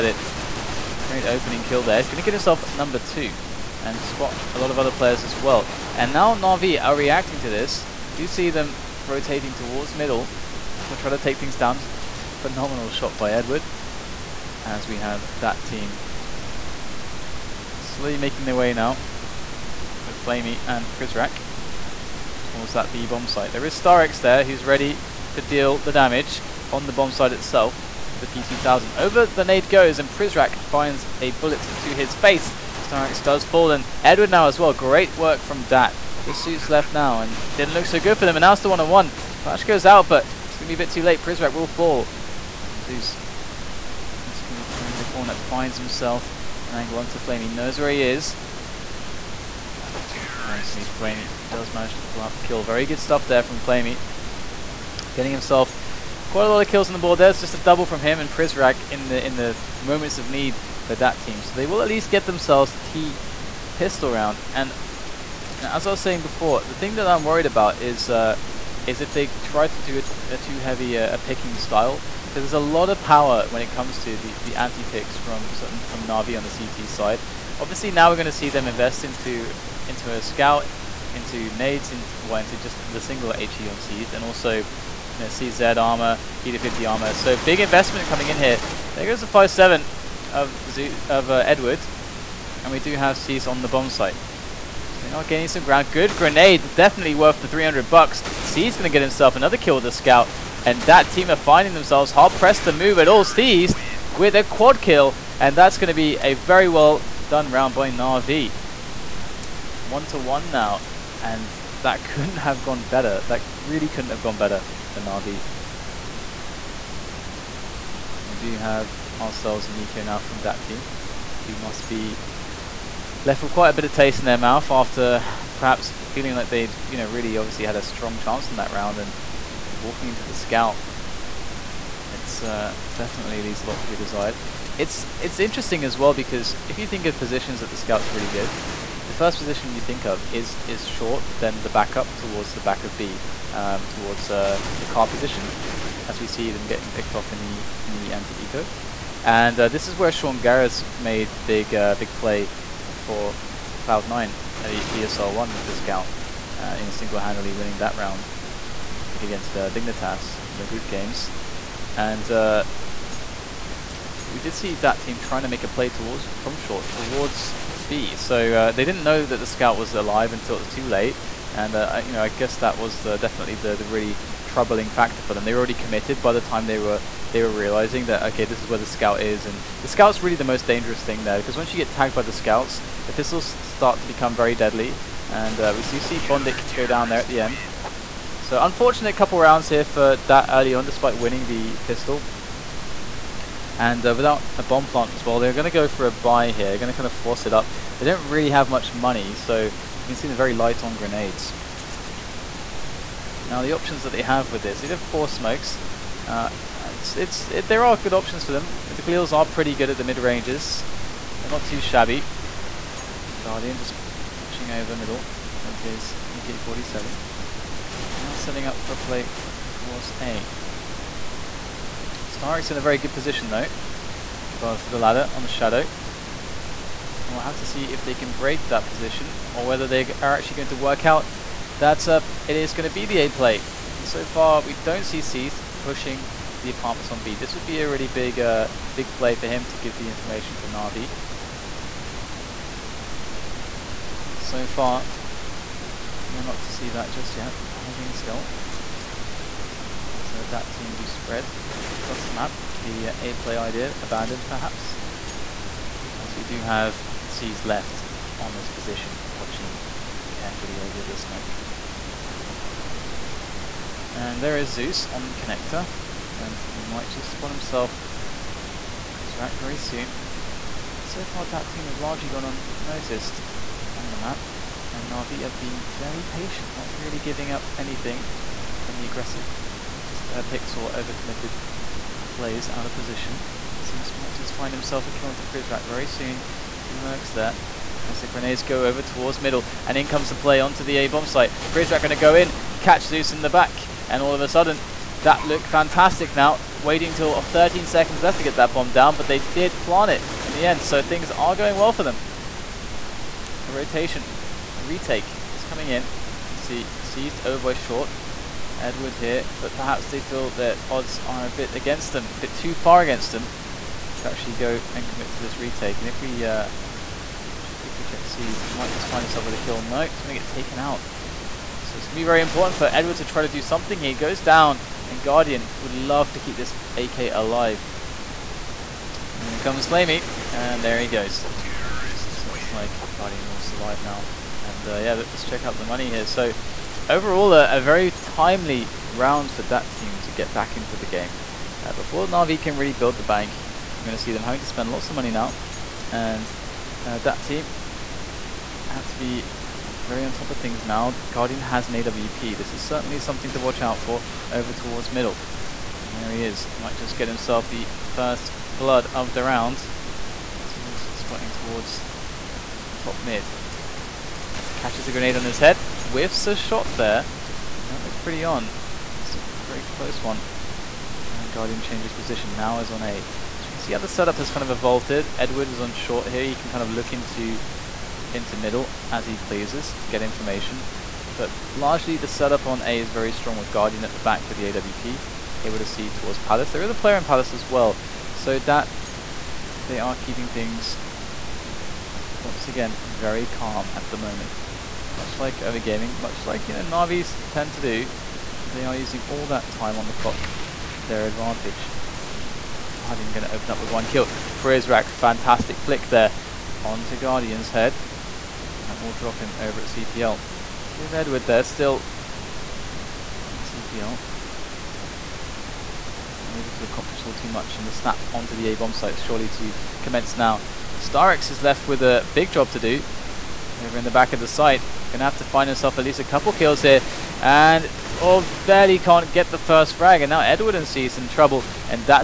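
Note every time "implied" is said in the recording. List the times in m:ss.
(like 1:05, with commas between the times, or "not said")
not said.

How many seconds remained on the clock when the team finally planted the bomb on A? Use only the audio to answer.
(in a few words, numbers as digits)
13.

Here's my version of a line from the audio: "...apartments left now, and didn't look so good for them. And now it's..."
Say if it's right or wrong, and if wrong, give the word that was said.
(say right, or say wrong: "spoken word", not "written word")
wrong: "suits", not "apartments".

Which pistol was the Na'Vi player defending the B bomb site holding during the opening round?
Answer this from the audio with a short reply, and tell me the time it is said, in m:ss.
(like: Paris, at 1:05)
P2000, at 0:28.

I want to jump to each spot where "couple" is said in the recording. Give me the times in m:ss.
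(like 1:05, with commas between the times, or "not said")
3:09, 7:06.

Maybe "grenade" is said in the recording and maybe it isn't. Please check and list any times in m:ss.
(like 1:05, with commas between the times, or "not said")
1:36, 3:20, 4:48, 6:05.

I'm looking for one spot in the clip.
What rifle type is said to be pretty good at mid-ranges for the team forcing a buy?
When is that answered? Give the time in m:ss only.
3:29.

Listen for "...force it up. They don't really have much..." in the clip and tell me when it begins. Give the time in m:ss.
3:17.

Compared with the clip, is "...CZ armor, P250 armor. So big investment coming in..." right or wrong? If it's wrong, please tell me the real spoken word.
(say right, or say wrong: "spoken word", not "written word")
right.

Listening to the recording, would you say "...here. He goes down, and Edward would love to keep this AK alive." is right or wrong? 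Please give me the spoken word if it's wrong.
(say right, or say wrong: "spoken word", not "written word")
wrong: "Guardian", not "Edward".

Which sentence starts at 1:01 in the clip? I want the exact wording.
So they will at least get themselves the T pistol round.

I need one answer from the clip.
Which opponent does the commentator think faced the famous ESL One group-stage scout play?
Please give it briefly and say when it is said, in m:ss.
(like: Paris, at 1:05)
Dignitas, at 2:39.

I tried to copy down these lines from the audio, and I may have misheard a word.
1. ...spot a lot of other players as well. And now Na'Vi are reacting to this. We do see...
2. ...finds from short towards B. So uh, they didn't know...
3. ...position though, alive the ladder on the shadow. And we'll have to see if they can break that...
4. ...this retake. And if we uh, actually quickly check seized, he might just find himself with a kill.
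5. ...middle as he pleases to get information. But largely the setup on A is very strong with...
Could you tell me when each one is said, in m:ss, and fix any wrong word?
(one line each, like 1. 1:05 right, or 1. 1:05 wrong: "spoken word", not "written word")
1. 0:03 right
2. 2:45 wrong: "towards", not "finds"
3. 3:43 wrong: "above", not "alive"
4. 5:15 right
5. 6:18 right.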